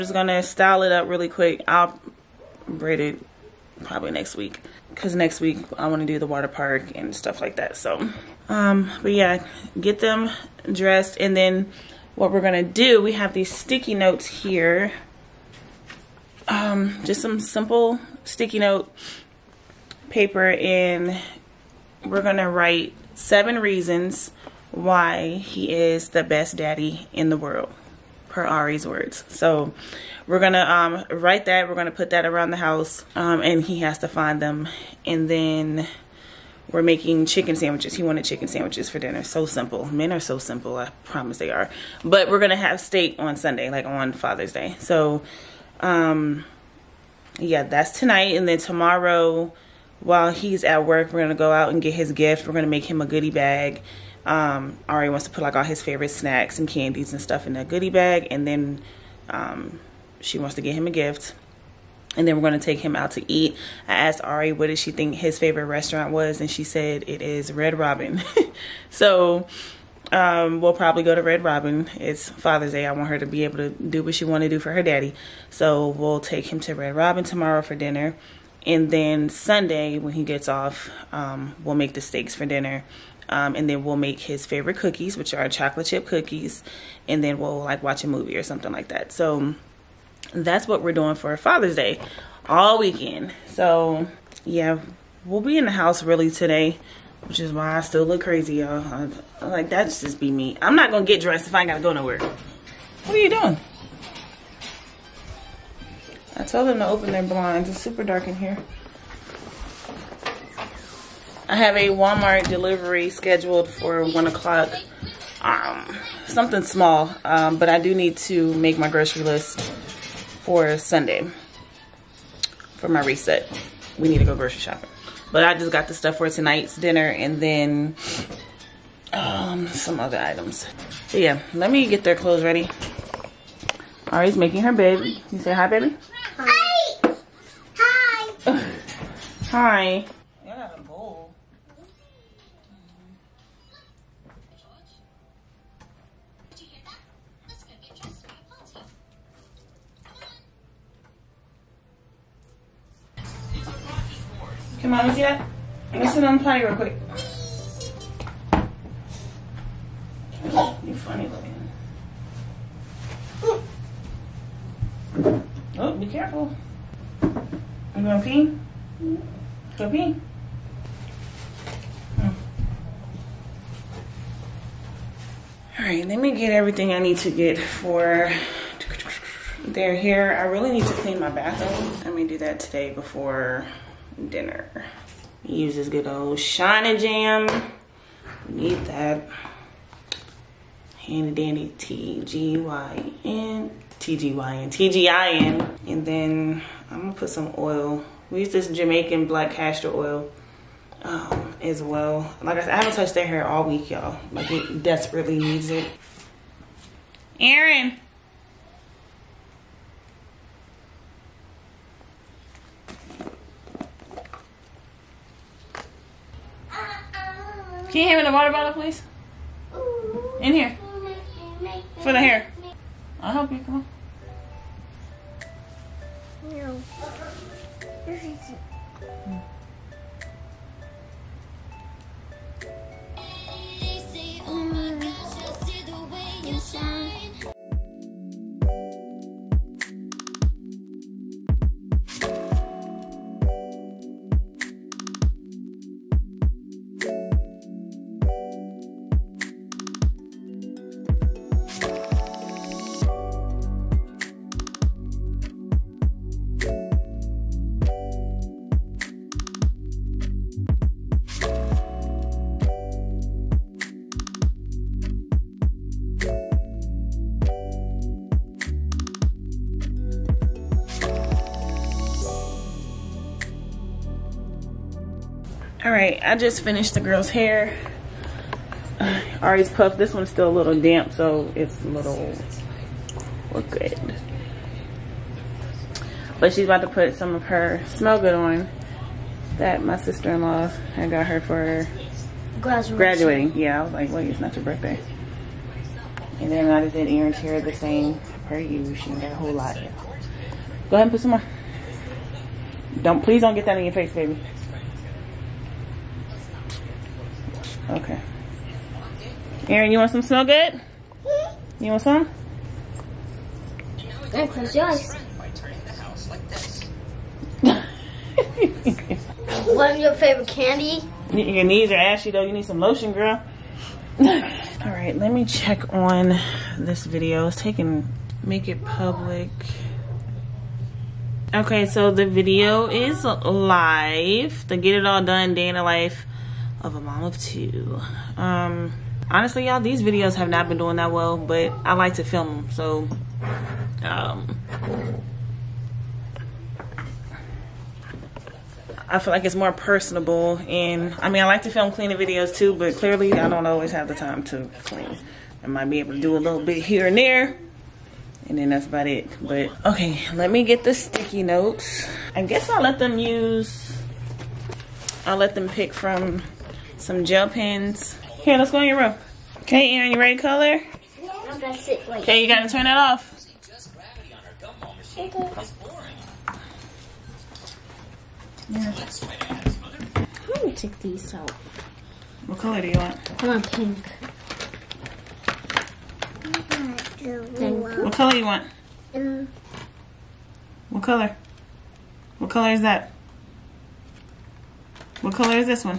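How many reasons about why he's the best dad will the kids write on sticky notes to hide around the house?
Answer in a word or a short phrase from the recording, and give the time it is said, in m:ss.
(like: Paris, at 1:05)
7, at 0:23.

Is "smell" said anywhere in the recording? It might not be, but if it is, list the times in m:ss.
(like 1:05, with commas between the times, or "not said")
4:47, 5:10.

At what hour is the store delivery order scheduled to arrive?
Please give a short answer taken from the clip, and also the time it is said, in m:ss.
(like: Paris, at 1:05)
1 o'clock, at 1:54.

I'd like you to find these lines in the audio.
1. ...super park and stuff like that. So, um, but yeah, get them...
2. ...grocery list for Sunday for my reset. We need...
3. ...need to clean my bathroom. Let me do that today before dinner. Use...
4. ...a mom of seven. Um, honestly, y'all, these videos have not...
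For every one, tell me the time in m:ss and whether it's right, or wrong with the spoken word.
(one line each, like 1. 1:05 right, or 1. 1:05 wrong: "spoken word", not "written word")
1. 0:06 wrong: "water", not "super"
2. 1:58 right
3. 3:00 right
4. 5:36 wrong: "two", not "seven".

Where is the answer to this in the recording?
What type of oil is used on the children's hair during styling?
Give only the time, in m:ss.
3:18.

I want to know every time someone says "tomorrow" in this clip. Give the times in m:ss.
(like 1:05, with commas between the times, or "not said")
0:48, 1:17.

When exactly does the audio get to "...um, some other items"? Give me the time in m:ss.
2:09.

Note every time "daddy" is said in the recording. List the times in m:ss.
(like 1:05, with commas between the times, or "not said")
0:26, 1:14.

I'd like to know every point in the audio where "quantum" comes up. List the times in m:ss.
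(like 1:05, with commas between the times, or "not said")
not said.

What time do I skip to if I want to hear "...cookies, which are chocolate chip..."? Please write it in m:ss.
1:24.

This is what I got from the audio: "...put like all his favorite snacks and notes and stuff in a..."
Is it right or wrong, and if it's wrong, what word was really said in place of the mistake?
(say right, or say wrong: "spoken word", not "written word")
wrong: "candies", not "notes".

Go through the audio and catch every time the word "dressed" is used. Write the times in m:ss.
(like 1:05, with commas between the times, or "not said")
0:10, 1:41.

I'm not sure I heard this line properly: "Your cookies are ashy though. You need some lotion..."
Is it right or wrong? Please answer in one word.
wrong.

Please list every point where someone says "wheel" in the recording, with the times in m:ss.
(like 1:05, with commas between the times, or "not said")
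not said.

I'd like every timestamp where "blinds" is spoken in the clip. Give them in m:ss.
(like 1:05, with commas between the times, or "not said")
1:47.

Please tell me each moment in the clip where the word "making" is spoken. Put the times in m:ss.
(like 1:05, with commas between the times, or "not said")
0:36, 2:14.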